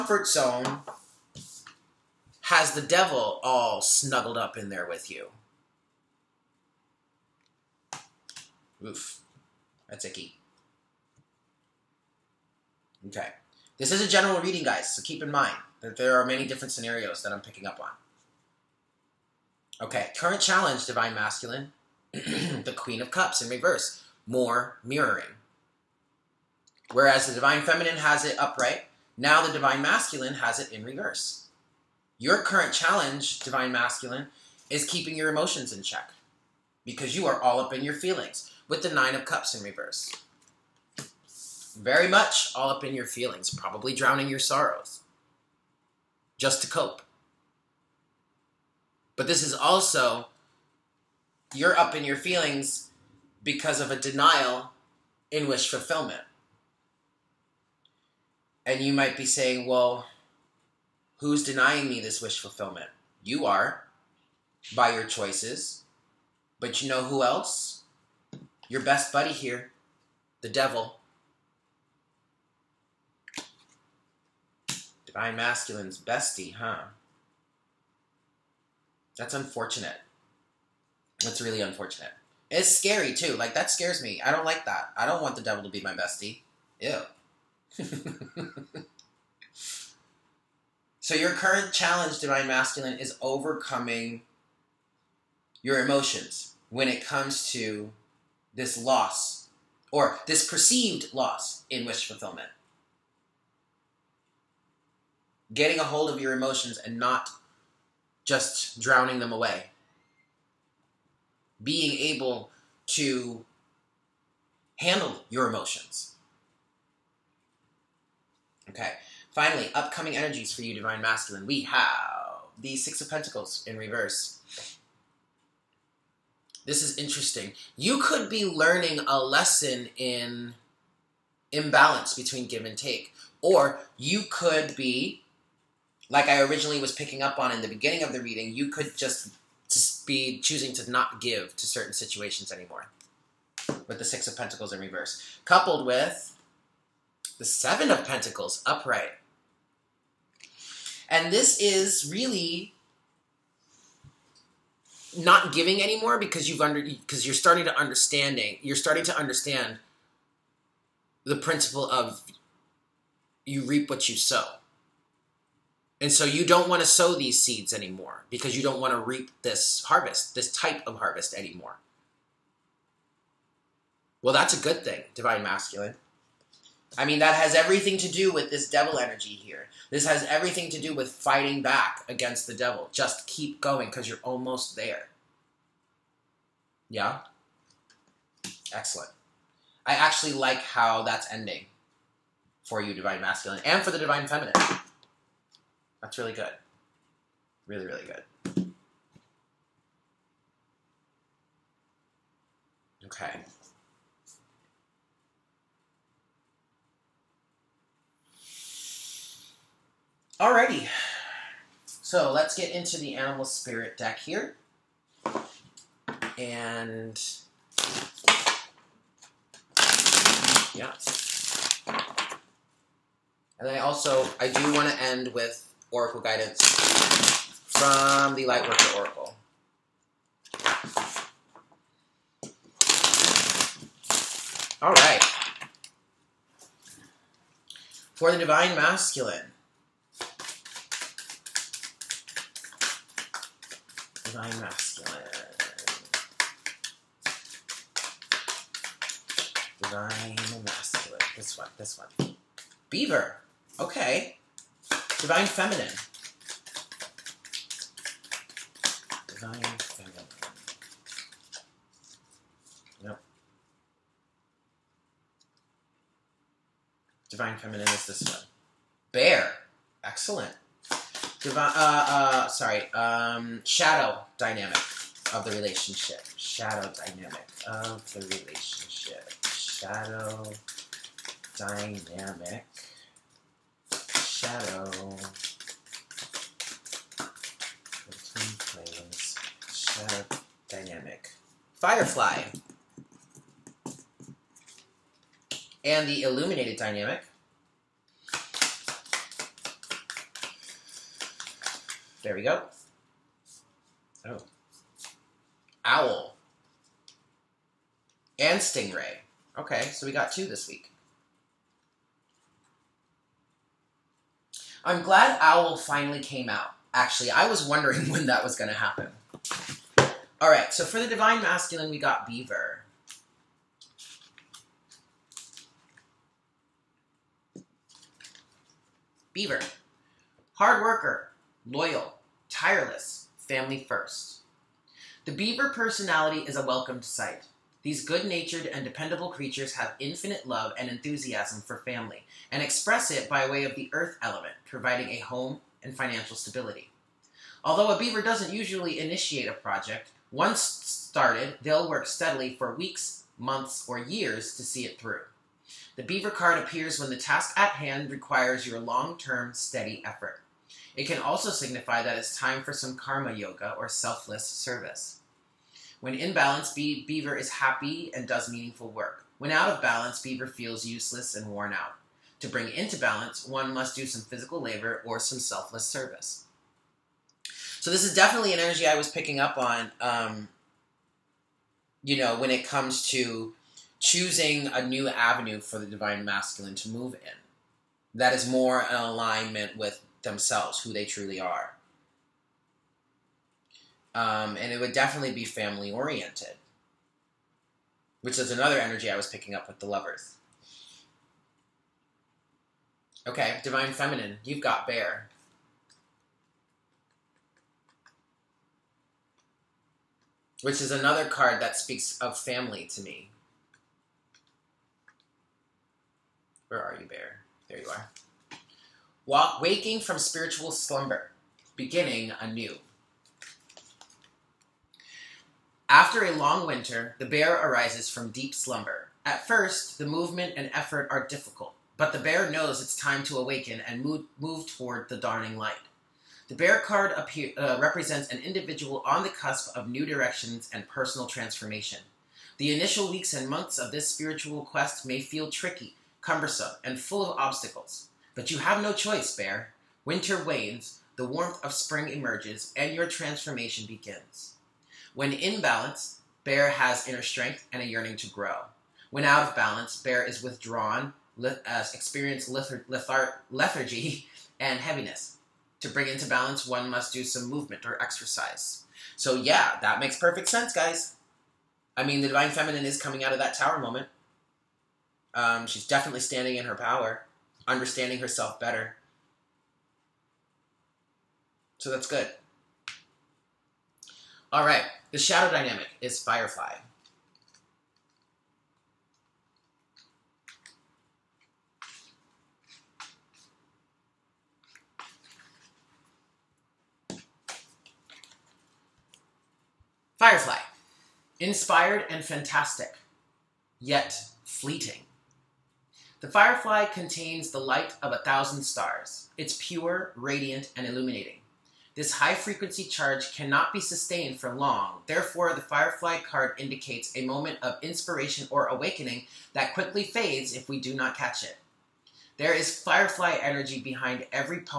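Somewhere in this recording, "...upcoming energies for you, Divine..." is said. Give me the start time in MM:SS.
01:59.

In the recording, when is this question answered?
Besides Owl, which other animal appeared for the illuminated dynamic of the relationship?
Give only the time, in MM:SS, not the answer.
05:08.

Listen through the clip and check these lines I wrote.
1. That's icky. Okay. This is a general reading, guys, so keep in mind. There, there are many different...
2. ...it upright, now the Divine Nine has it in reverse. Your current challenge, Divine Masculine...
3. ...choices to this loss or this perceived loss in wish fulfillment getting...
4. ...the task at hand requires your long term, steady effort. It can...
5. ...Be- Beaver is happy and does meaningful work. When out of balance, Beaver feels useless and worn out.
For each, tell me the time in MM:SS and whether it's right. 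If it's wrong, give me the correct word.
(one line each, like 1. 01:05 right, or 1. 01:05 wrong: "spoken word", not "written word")
1. 00:09 right
2. 00:28 wrong: "Masculine", not "Nine"
3. 01:37 wrong: "comes", not "choices"
4. 05:57 right
5. 06:06 right.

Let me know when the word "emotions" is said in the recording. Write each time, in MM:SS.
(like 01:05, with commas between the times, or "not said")
00:35, 01:35, 01:46, 01:55.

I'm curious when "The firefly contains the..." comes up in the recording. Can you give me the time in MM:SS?
08:26.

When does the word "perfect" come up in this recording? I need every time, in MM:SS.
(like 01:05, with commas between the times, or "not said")
07:50.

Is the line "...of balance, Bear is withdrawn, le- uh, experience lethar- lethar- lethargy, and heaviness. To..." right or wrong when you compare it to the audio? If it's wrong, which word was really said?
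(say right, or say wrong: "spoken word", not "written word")
right.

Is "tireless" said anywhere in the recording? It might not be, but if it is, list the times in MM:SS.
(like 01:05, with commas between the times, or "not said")
05:32.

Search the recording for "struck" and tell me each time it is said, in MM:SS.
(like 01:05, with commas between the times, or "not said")
not said.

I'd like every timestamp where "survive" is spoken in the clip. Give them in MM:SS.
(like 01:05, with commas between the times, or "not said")
not said.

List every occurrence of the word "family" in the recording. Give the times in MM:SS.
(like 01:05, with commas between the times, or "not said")
05:33, 05:41, 06:35, 06:52.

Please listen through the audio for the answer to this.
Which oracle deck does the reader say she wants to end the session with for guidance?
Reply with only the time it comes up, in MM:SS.
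03:48.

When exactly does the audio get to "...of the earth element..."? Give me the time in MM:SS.
05:43.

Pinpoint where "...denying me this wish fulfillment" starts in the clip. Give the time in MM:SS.
01:01.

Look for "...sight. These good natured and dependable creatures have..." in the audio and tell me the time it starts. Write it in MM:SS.
05:37.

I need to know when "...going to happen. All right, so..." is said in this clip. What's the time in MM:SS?
05:18.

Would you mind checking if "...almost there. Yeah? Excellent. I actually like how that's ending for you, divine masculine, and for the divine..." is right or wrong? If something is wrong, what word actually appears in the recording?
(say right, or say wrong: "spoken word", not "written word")
right.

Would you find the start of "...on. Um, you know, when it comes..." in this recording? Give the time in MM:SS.
06:19.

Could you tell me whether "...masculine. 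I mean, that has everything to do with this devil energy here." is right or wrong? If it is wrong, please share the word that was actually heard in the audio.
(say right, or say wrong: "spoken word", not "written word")
right.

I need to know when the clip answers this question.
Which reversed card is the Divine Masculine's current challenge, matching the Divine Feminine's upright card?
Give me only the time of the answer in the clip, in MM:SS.
00:22.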